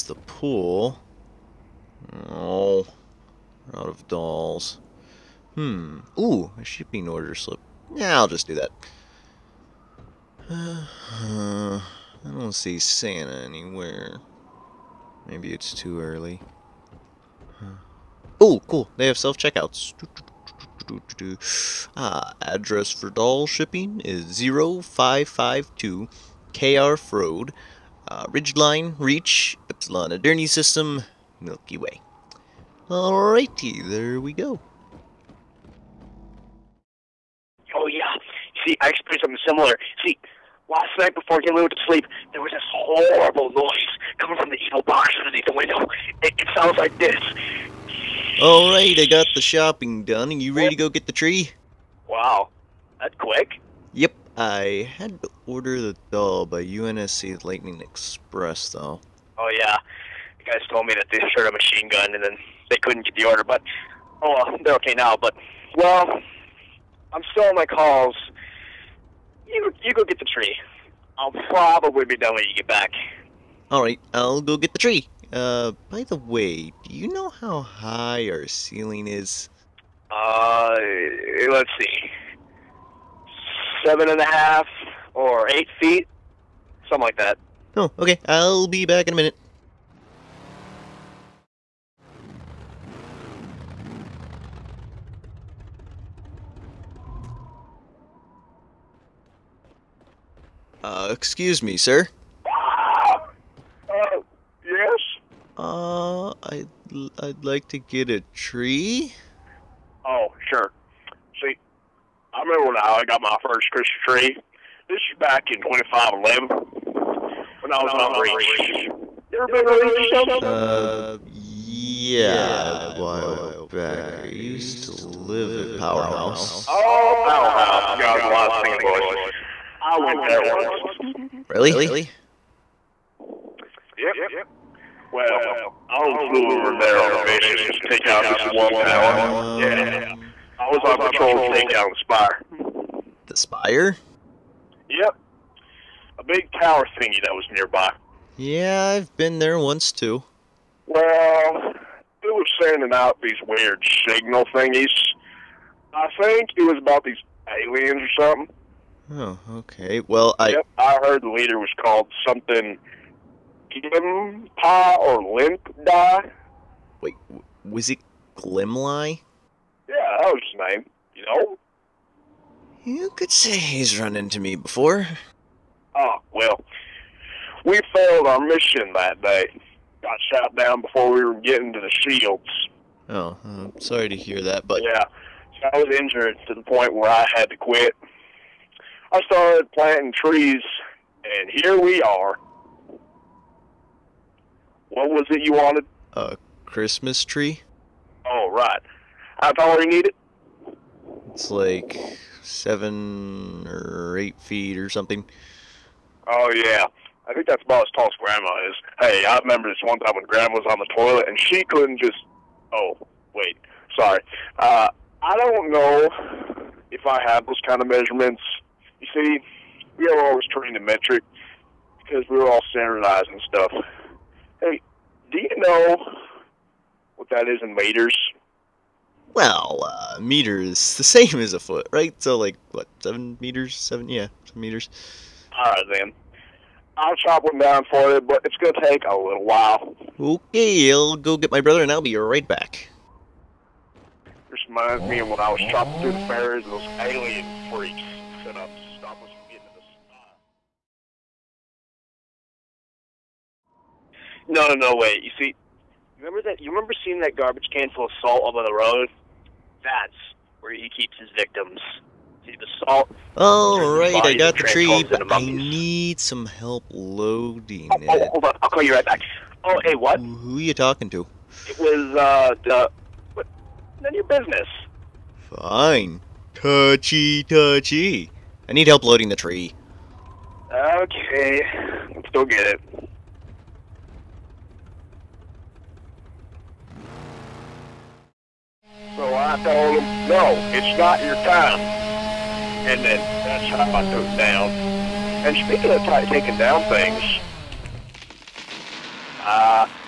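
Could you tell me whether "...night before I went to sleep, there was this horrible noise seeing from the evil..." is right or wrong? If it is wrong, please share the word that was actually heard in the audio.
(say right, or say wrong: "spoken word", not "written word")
wrong: "coming", not "seeing".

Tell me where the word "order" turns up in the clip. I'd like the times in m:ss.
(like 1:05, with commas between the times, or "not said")
0:07, 0:55, 1:03.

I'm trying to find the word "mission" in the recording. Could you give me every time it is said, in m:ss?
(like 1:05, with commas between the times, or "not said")
2:17, 2:58.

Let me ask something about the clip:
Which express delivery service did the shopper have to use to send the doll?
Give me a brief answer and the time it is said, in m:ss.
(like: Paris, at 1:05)
UNSC Lightning Express, at 0:56.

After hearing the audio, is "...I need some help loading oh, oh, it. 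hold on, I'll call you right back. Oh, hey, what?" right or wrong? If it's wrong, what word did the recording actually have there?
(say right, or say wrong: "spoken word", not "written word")
right.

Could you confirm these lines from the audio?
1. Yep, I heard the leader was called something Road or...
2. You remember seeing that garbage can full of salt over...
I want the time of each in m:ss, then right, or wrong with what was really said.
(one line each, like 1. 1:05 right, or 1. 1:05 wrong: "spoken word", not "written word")
1. 2:40 wrong: "Glimpa", not "Road"
2. 4:16 right.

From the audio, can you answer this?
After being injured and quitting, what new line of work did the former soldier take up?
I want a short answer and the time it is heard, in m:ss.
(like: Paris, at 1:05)
Planting trees, at 3:09.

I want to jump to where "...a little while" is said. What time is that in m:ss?
3:59.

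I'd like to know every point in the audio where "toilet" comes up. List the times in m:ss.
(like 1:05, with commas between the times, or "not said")
3:30.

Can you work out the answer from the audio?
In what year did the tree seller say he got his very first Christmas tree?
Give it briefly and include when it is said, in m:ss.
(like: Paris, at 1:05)
2511, at 1:55.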